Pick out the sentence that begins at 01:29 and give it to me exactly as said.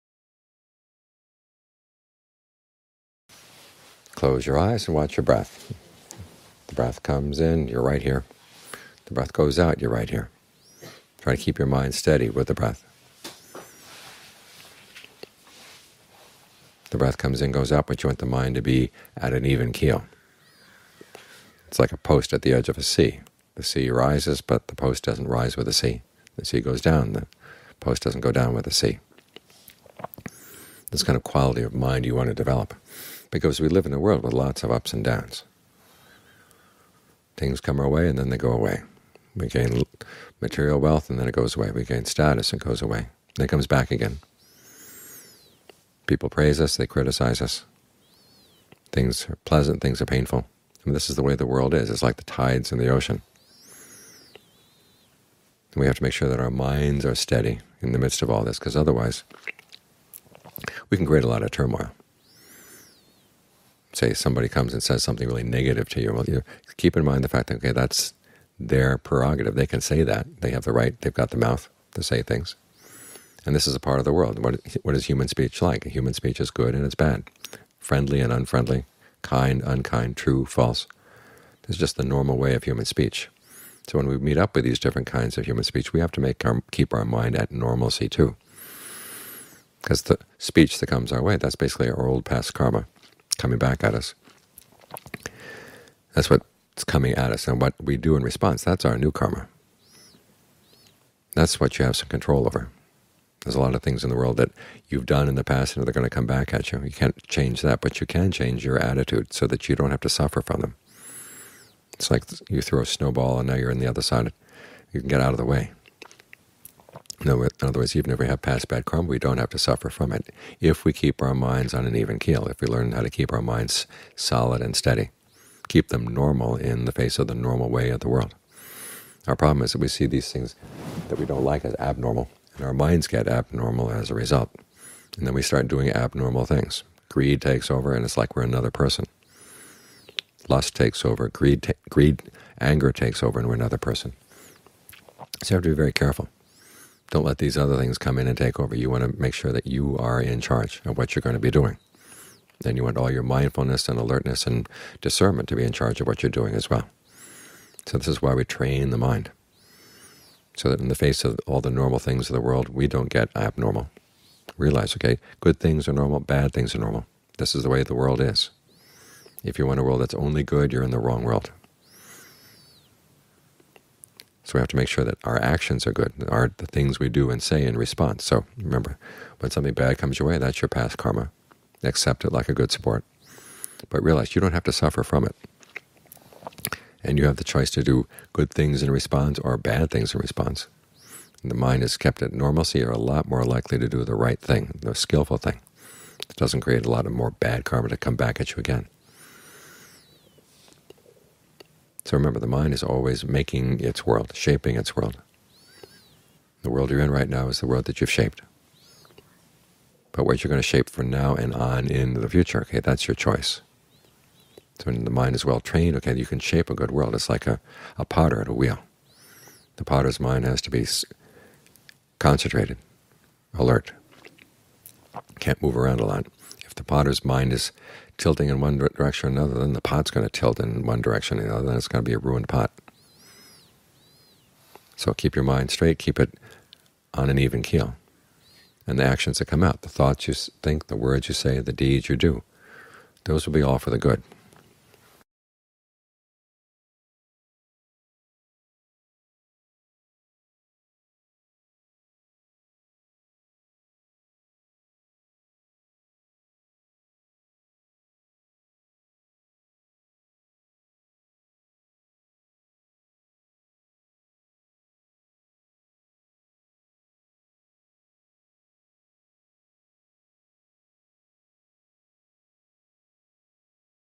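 Because the speech that comes our way, that's basically our old past karma coming back at us.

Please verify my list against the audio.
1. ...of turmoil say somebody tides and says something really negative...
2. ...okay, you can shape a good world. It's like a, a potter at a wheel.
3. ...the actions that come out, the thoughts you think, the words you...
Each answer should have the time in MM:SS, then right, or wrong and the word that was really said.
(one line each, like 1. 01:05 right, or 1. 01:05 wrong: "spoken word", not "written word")
1. 01:01 wrong: "comes", not "tides"
2. 03:35 right
3. 03:58 right.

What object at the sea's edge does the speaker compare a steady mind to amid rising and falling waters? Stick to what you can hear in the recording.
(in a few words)
a post.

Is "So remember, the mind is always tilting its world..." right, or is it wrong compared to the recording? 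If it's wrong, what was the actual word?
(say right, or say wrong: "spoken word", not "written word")
wrong: "making", not "tilting".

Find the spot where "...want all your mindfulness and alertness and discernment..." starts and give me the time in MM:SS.
02:32.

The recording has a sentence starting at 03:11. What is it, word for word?
And the mind is kept at normalcy, you're a lot more likely to do the right thing, the skillful thing.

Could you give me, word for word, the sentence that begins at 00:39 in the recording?
We gain material wealth and then it goes away.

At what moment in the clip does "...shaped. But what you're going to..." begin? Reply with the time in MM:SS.
03:28.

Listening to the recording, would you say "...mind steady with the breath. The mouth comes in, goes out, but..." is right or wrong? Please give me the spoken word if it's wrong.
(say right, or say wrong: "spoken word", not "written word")
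wrong: "breath", not "mouth".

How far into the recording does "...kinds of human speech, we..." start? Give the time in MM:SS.
01:25.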